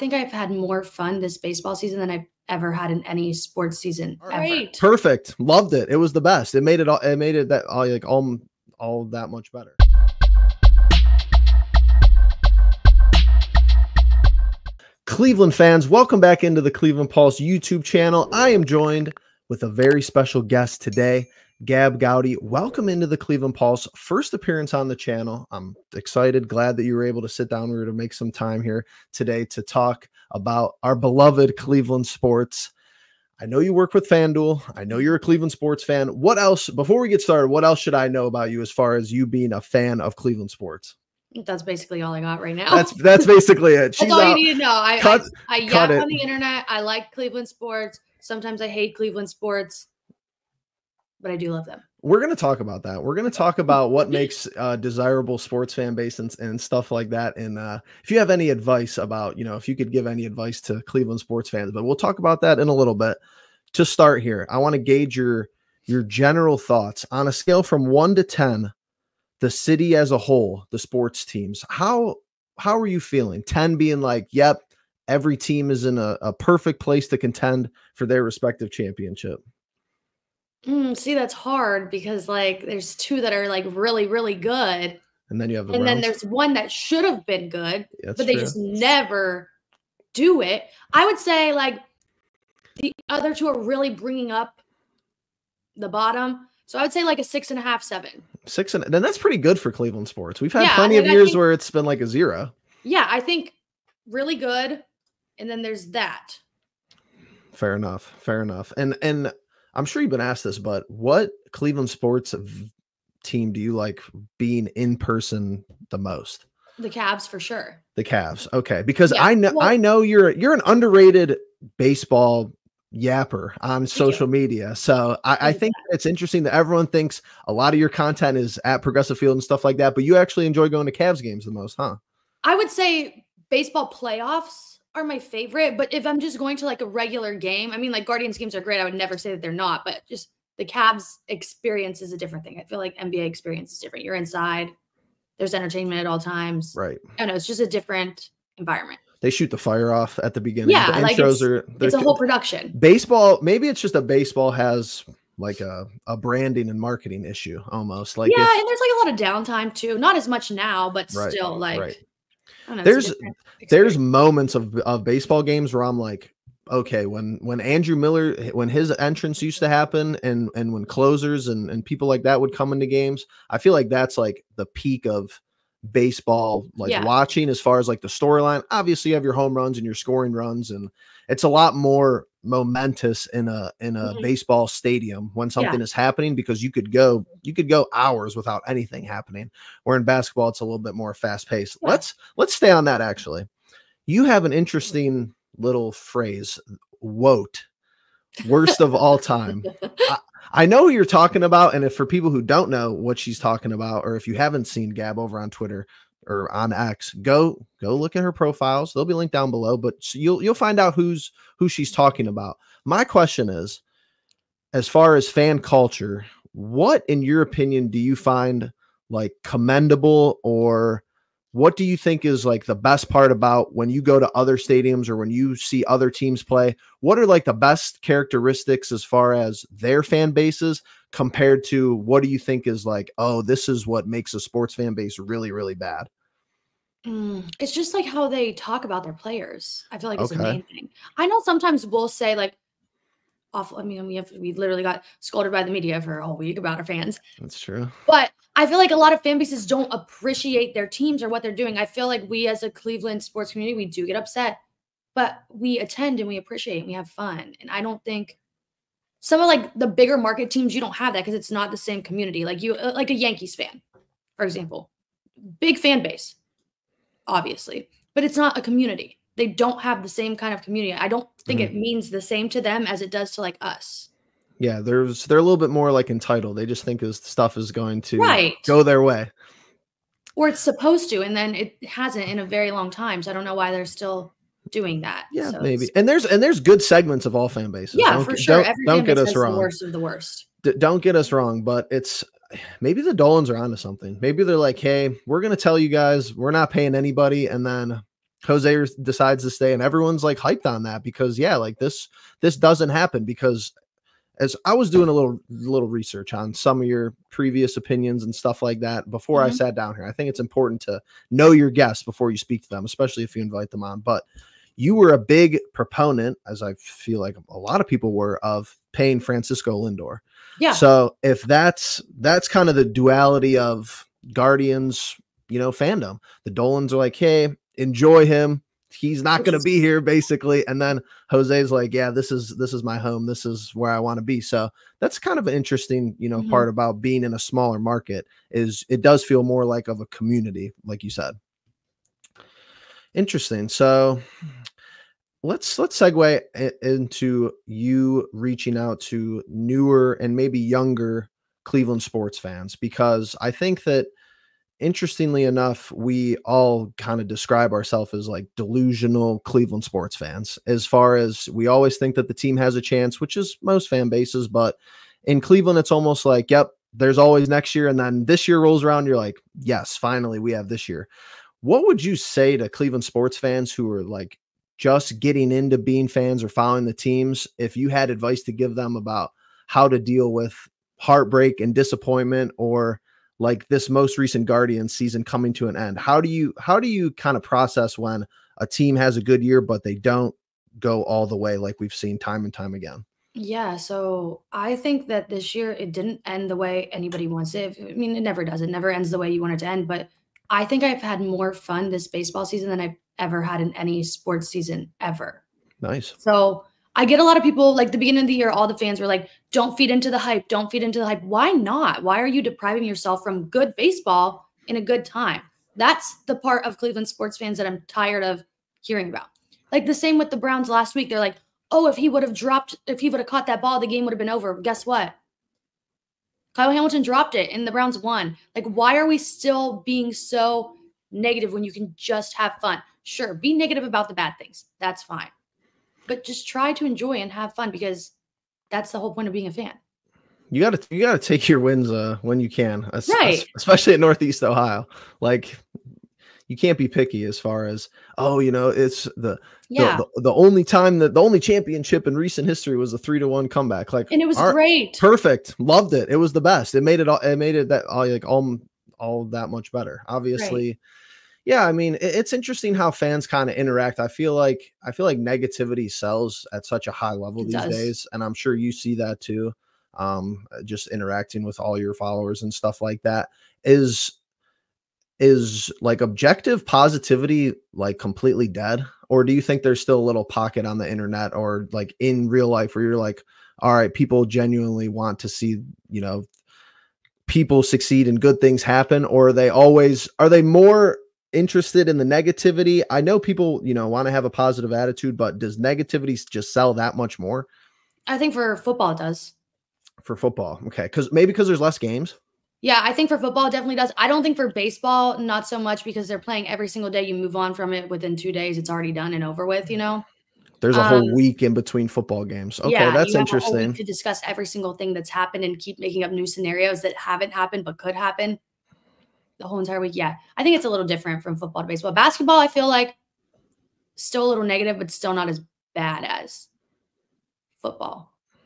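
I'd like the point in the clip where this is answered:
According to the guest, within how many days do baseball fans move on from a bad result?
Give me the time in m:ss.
8:28.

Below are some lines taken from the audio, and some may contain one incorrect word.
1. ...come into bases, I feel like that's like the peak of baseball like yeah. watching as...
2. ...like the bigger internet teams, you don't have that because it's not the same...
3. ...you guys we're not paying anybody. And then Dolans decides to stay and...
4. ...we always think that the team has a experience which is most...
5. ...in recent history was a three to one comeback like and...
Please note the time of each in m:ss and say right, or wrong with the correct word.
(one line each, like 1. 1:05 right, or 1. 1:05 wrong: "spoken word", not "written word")
1. 2:52 wrong: "games", not "bases"
2. 4:19 wrong: "market", not "internet"
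3. 4:55 wrong: "Jose", not "Dolans"
4. 6:01 wrong: "chance", not "experience"
5. 7:32 right.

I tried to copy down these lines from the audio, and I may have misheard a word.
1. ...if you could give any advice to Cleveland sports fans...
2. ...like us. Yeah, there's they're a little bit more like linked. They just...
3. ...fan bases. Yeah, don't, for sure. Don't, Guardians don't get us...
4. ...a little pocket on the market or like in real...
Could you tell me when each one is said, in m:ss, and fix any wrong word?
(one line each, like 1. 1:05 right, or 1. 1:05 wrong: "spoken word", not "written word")
1. 0:59 right
2. 4:33 wrong: "entitled", not "linked"
3. 4:47 wrong: "Every", not "Guardians"
4. 7:59 wrong: "internet", not "market".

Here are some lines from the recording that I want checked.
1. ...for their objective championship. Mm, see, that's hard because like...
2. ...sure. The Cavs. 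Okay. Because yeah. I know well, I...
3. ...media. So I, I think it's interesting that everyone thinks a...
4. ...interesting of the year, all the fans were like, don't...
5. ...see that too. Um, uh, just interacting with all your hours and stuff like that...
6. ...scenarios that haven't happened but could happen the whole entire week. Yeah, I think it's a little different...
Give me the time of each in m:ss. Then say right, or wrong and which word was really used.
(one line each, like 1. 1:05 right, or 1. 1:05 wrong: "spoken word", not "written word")
1. 1:17 wrong: "respective", not "objective"
2. 1:57 right
3. 2:04 right
4. 6:47 wrong: "beginning", not "interesting"
5. 7:48 wrong: "followers", not "hours"
6. 8:36 right.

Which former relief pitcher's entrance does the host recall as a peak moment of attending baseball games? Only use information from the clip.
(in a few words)
Andrew Miller.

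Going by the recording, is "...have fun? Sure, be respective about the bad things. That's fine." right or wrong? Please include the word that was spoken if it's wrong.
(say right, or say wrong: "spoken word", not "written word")
wrong: "negative", not "respective".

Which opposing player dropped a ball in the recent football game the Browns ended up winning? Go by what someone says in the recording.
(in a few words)
Kyle Hamilton.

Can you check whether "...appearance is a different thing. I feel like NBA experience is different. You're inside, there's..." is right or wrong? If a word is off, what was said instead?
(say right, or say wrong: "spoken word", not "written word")
wrong: "experience", not "appearance".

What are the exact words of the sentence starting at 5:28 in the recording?
He's not going to be here, basically.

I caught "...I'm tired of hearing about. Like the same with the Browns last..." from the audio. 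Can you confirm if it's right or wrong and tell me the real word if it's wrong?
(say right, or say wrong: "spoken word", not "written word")
right.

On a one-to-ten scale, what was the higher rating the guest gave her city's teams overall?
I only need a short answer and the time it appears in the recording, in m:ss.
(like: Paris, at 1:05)
7, at 1:37.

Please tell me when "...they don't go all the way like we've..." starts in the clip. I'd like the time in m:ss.
6:29.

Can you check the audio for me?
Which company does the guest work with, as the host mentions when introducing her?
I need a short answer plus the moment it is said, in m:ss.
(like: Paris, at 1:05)
FanDuel, at 0:34.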